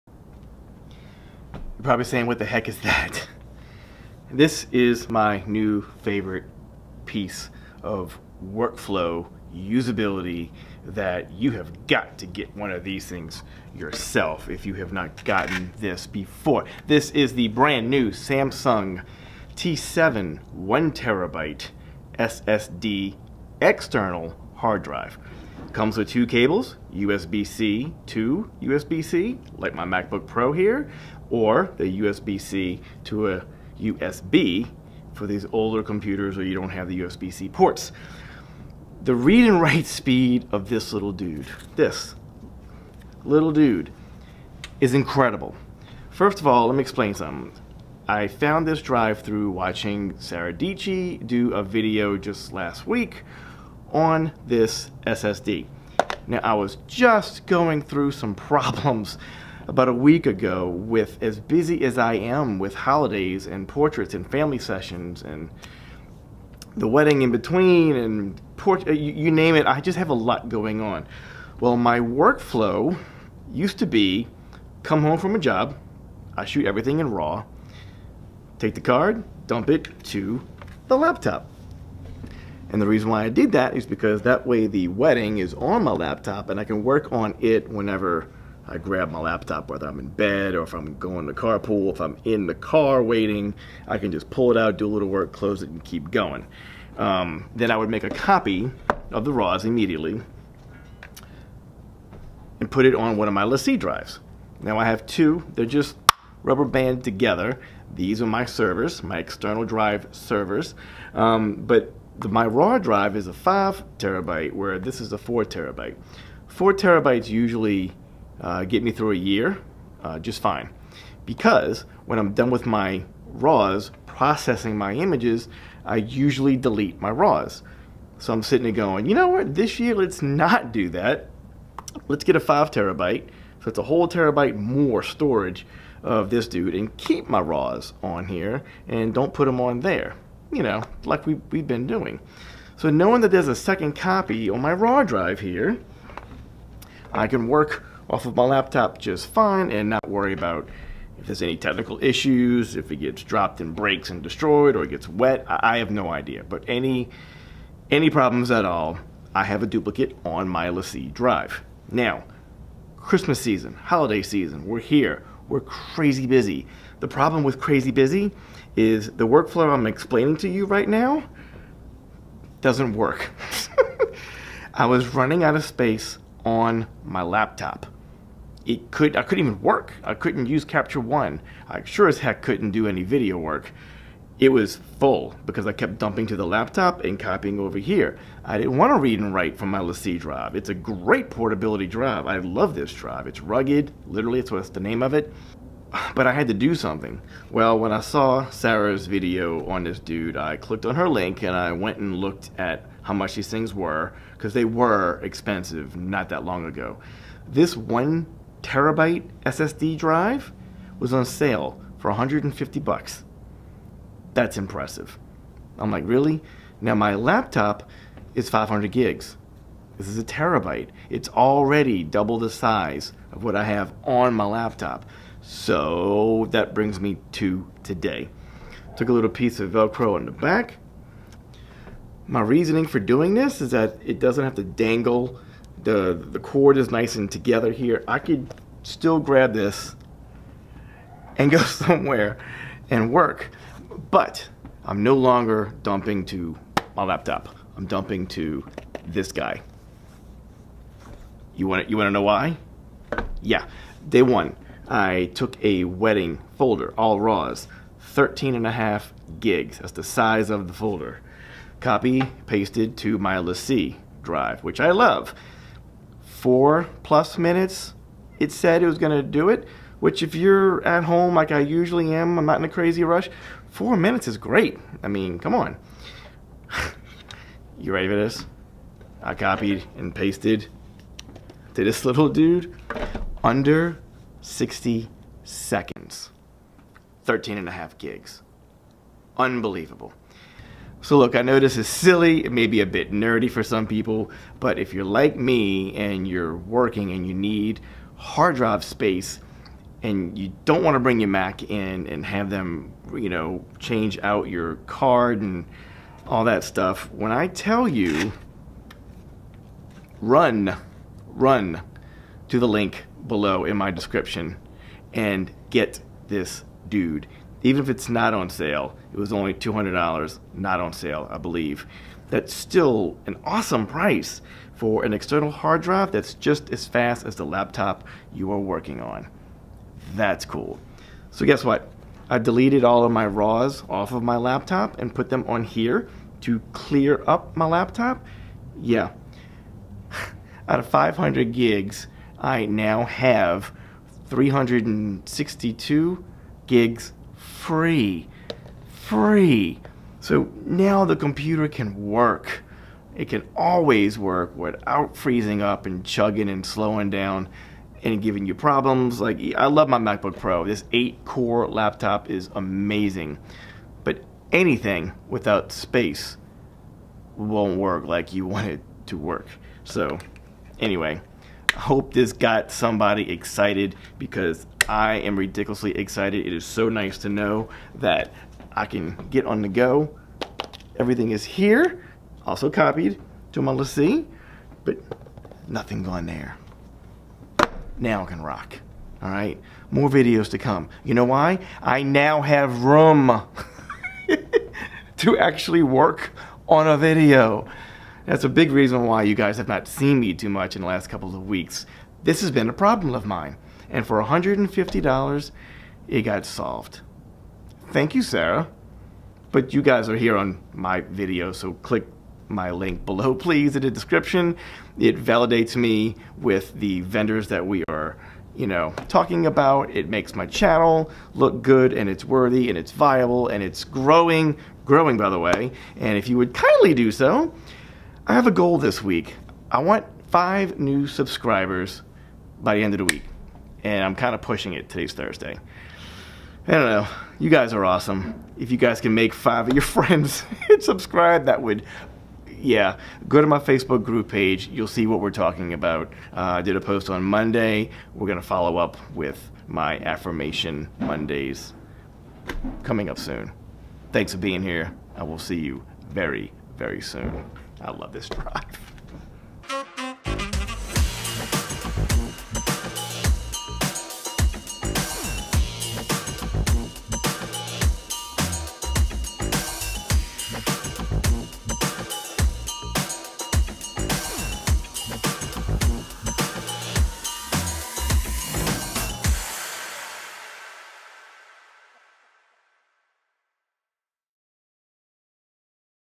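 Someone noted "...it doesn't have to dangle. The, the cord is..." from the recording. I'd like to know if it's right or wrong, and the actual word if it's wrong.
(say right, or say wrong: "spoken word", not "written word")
right.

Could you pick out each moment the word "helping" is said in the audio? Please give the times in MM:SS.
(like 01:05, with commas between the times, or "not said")
not said.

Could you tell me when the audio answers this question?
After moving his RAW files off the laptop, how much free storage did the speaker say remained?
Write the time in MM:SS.
05:44.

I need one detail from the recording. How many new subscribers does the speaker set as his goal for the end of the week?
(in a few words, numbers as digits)
5.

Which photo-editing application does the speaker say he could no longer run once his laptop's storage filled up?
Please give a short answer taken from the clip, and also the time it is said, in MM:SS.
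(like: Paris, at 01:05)
Capture One, at 03:00.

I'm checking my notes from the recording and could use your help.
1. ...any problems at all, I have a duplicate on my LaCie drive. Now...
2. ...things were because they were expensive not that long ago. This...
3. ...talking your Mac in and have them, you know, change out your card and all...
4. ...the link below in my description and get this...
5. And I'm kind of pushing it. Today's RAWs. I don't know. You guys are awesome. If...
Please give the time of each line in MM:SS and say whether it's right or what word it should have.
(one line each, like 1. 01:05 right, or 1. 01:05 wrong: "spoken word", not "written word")
1. 02:37 right
2. 03:23 right
3. 05:00 wrong: "bring", not "talking"
4. 05:12 right
5. 07:13 wrong: "Thursday", not "RAWs".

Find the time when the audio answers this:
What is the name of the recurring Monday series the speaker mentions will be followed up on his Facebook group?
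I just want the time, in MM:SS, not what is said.
07:29.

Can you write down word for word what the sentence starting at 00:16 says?
This is the brand new Samsung T7 1 terabyte SSD external hard drive.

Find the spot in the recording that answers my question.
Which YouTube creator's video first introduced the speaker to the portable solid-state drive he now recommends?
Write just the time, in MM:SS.
00:50.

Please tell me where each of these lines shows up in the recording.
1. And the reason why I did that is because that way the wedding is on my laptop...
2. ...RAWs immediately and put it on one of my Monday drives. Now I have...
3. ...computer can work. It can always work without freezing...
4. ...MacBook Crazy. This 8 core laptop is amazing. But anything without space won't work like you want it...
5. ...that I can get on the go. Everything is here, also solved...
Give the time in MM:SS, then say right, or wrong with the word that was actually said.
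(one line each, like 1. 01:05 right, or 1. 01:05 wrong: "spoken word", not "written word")
1. 01:22 right
2. 01:39 wrong: "LaCie", not "Monday"
3. 05:51 right
4. 05:59 wrong: "Pro", not "Crazy"
5. 06:17 wrong: "copied", not "solved".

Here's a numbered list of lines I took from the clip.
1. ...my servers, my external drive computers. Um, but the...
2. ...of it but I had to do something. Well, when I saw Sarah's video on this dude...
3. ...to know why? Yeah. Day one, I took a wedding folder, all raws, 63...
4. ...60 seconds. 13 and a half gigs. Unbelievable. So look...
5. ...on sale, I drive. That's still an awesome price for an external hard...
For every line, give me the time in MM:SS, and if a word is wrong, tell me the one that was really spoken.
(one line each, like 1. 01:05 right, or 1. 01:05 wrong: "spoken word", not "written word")
1. 01:48 wrong: "servers", not "computers"
2. 03:15 right
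3. 04:12 wrong: "13", not "63"
4. 04:44 right
5. 05:20 wrong: "believe", not "drive".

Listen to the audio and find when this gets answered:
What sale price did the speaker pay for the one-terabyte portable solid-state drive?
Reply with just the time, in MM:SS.
03:32.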